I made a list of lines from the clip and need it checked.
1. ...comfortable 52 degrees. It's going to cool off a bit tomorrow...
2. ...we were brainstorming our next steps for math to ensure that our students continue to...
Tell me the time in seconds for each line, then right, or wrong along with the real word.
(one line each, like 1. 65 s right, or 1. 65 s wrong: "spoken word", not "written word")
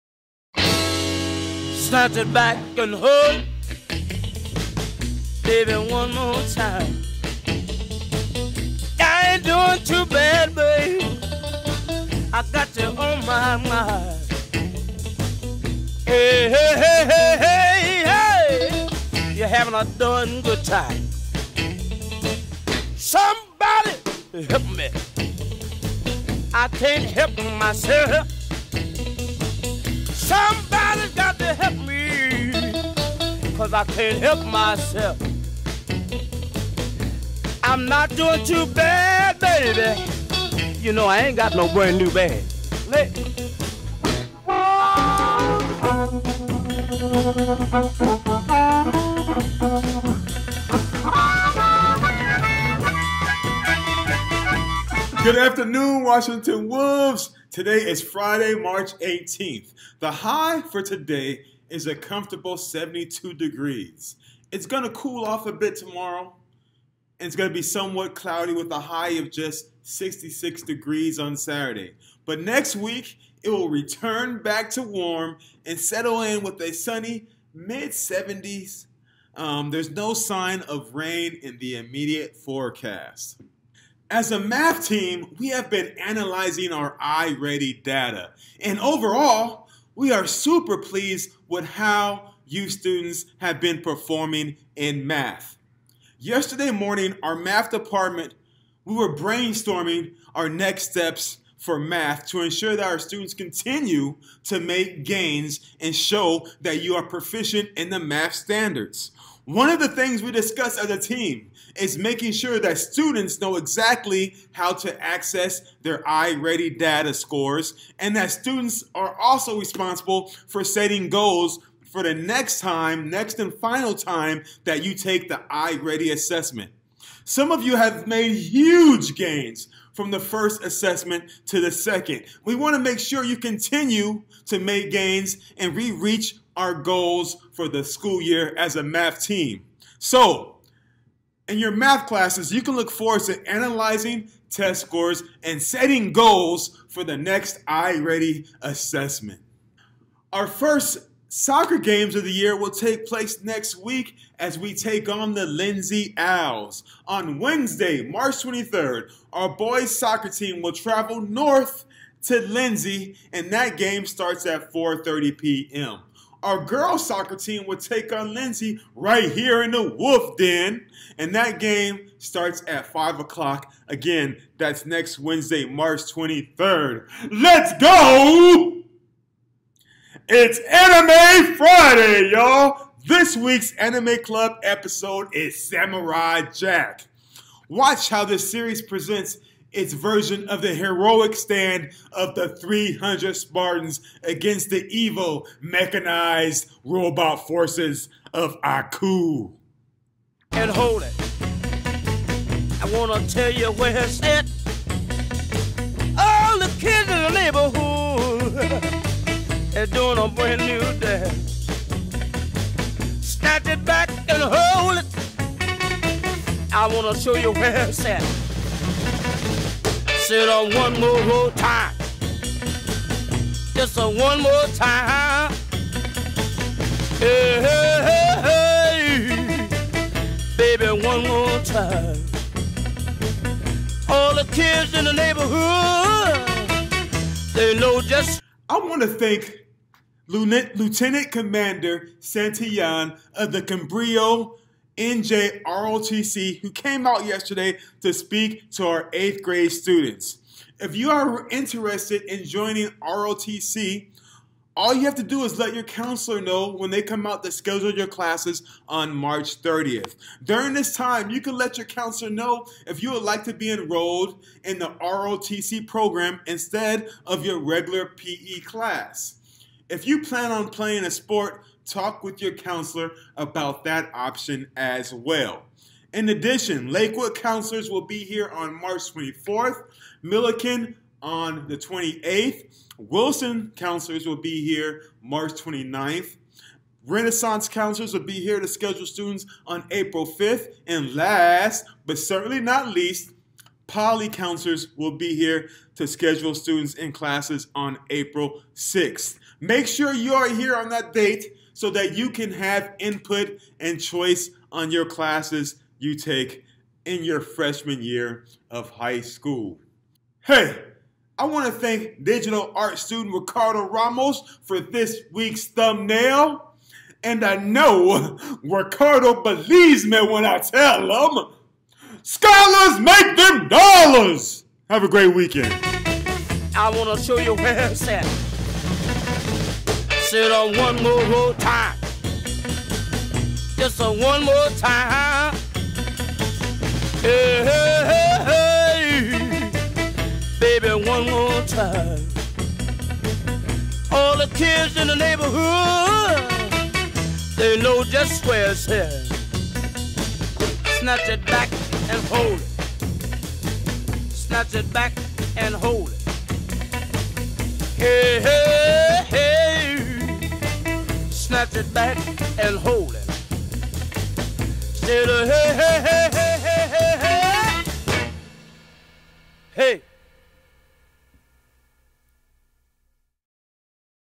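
1. 61 s wrong: "72", not "52"
2. 98 s right.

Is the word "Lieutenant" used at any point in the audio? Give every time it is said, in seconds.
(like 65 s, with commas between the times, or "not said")
240 s.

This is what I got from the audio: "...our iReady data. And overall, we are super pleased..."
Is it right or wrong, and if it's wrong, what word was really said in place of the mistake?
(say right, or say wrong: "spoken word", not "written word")
right.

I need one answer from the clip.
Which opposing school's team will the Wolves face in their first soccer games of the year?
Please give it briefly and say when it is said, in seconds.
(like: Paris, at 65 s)
Lindsay Owls, at 155 s.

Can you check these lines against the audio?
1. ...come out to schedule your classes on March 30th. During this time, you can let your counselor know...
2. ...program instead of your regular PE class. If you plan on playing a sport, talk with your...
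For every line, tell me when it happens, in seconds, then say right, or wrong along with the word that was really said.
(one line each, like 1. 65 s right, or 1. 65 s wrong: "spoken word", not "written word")
1. 257 s right
2. 265 s right.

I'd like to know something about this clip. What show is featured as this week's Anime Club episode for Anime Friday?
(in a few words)
Samurai Jack.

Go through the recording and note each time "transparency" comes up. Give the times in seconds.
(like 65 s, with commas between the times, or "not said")
not said.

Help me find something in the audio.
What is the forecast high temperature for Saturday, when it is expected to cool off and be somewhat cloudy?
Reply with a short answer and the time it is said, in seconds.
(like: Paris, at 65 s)
66 degrees, at 69 s.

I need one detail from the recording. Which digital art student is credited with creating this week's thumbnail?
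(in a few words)
Ricardo Ramos.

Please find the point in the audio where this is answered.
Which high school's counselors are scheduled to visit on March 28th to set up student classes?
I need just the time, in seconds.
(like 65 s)
280 s.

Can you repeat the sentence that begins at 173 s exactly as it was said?
Again, that's next Wednesday, March 23rd.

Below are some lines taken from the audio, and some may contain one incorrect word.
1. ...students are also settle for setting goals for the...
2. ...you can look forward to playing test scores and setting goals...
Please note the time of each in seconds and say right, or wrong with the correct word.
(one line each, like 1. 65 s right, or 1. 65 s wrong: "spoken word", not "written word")
1. 118 s wrong: "responsible", not "settle"
2. 142 s wrong: "analyzing", not "playing".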